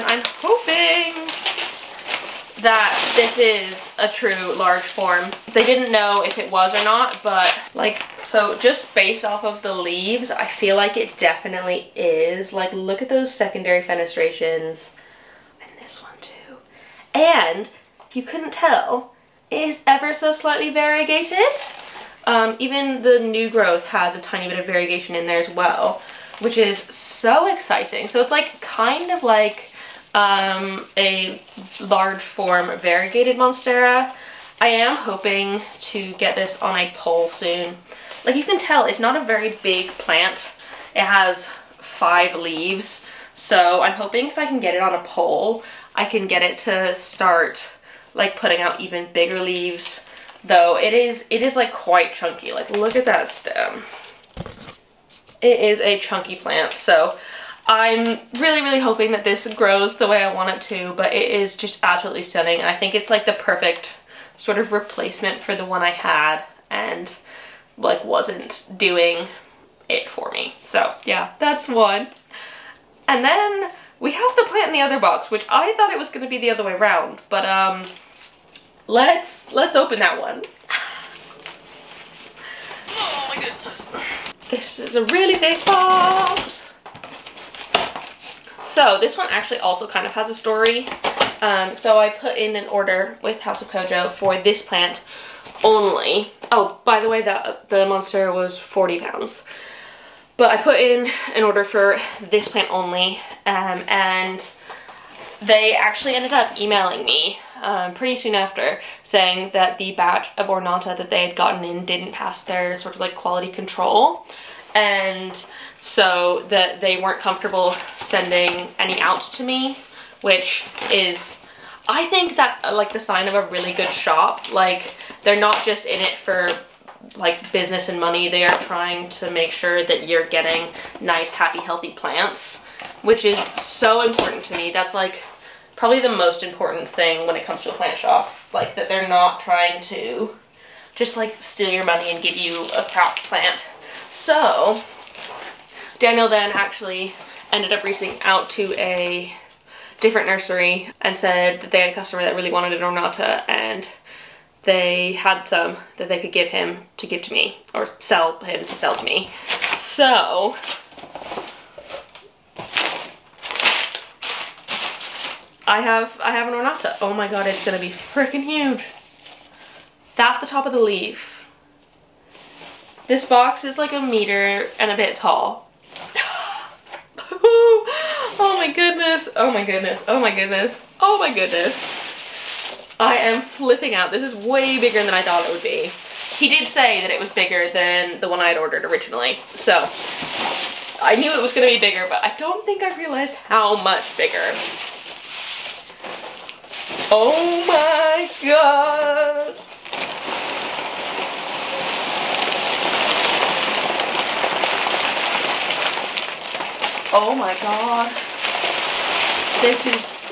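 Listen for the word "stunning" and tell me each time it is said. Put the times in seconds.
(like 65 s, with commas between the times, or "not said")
62 s.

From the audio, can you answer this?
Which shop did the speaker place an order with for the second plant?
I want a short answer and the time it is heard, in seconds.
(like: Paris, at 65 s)
House of Kojo, at 93 s.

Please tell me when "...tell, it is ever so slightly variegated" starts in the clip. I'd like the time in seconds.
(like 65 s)
18 s.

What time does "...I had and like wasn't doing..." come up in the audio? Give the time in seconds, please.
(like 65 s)
65 s.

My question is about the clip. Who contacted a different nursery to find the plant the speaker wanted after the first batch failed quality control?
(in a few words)
Daniel.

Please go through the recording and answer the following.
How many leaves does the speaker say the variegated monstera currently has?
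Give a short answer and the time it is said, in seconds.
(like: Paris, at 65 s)
5, at 41 s.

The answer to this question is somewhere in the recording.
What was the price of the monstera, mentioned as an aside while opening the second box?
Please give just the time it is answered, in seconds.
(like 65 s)
98 s.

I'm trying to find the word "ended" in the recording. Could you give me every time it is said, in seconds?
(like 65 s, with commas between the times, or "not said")
106 s, 147 s.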